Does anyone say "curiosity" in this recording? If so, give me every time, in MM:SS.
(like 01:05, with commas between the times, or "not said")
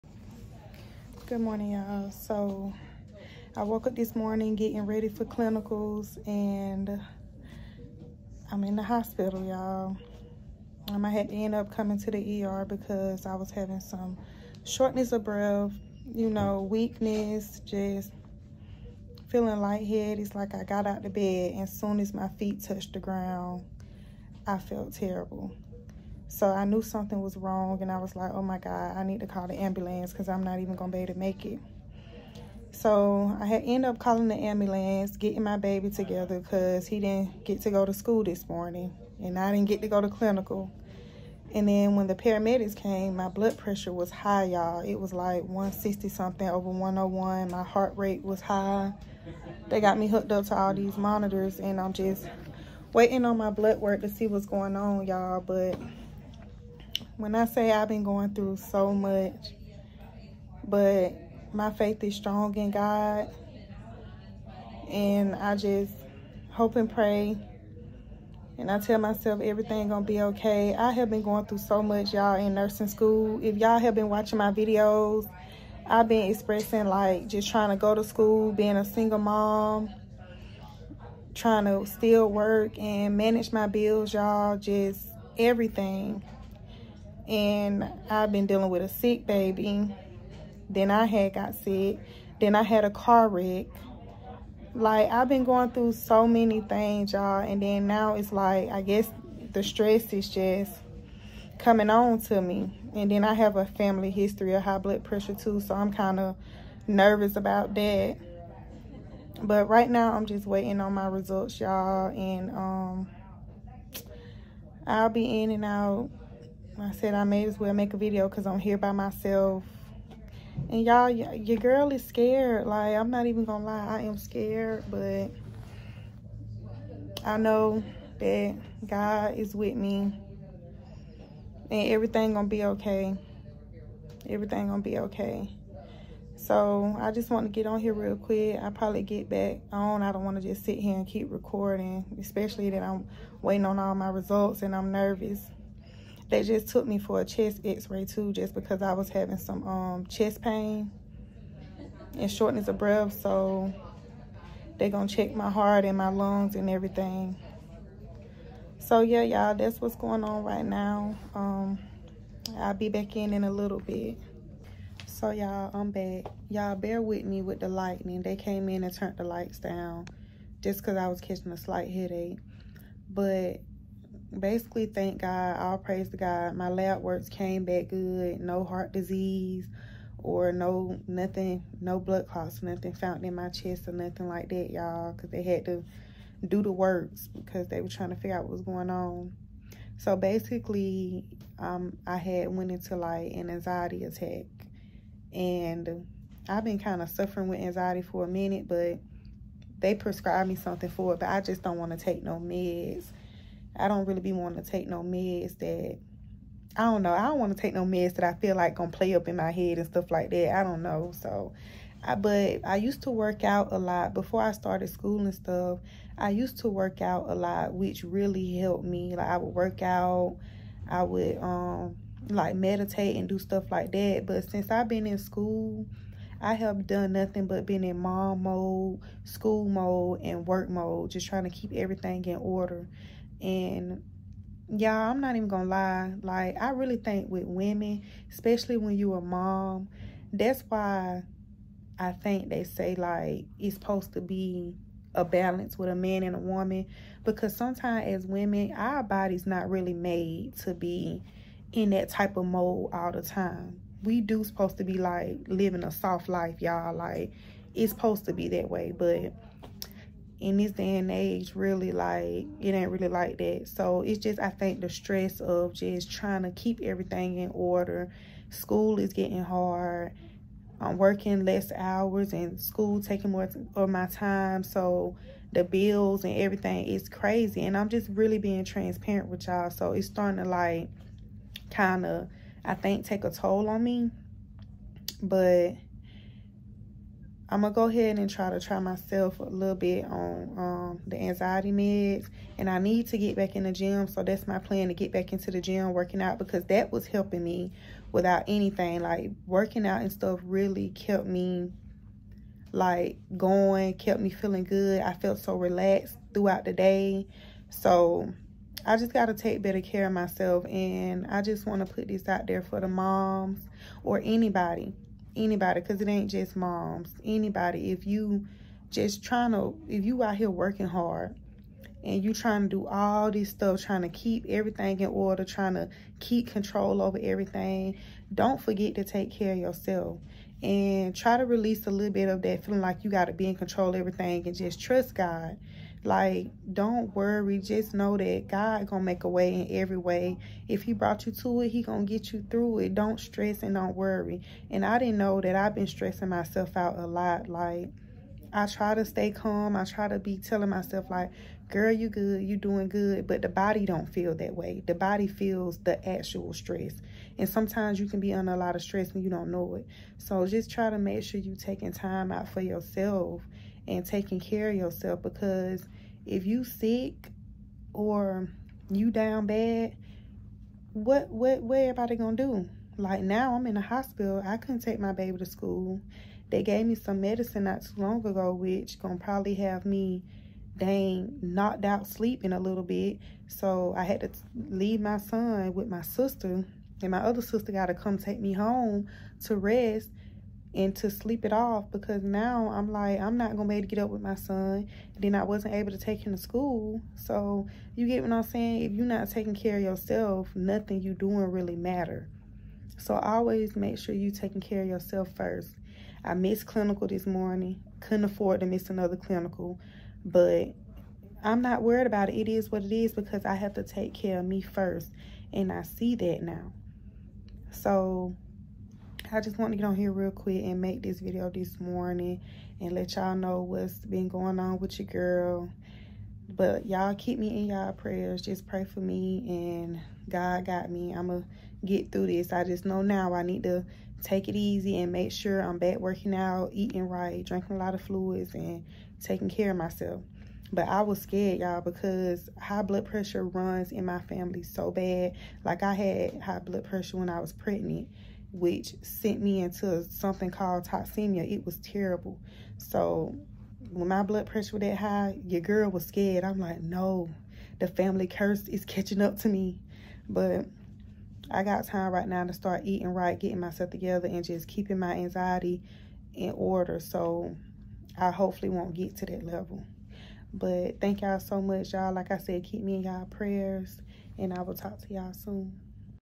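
not said.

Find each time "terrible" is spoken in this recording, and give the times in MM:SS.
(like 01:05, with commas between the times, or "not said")
00:24, 07:31.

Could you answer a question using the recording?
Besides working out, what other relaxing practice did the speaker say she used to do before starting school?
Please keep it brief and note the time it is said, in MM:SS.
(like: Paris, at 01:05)
Meditate, at 03:42.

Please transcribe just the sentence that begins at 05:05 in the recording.
I felt so relaxed throughout the day.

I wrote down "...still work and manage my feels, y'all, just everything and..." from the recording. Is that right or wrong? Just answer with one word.
wrong.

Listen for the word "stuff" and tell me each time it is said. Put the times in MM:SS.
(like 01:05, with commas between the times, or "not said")
03:29, 03:35, 03:43, 05:00, 05:23.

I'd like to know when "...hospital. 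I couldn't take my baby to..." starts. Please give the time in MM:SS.
06:13.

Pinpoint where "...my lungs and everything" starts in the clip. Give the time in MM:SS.
02:35.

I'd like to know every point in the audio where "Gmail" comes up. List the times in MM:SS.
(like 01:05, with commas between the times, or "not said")
not said.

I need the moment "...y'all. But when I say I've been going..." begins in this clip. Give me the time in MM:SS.
00:55.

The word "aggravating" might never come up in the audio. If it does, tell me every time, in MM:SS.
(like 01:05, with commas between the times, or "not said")
not said.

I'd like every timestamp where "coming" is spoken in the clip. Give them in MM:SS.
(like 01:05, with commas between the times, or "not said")
00:11, 01:41.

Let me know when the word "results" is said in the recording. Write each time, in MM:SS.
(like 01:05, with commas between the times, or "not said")
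01:51, 02:24.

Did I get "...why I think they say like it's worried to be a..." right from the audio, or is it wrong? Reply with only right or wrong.
wrong.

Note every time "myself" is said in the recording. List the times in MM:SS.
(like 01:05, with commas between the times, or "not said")
01:08, 01:58, 04:48, 05:10, 05:46, 05:50, 07:19, 07:43.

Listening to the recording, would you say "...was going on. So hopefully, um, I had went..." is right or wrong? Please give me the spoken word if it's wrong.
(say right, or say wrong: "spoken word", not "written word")
wrong: "basically", not "hopefully".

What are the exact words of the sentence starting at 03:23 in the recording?
I don't really be wanting to take no meds that I don't know.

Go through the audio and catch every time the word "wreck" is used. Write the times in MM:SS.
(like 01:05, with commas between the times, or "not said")
01:33.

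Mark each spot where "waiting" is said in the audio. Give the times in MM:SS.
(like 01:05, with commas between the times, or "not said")
00:52, 01:50, 02:23.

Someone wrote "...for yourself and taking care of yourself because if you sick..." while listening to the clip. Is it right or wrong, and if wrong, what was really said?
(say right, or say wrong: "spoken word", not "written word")
right.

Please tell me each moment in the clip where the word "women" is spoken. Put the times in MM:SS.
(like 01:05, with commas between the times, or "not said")
03:57, 04:08.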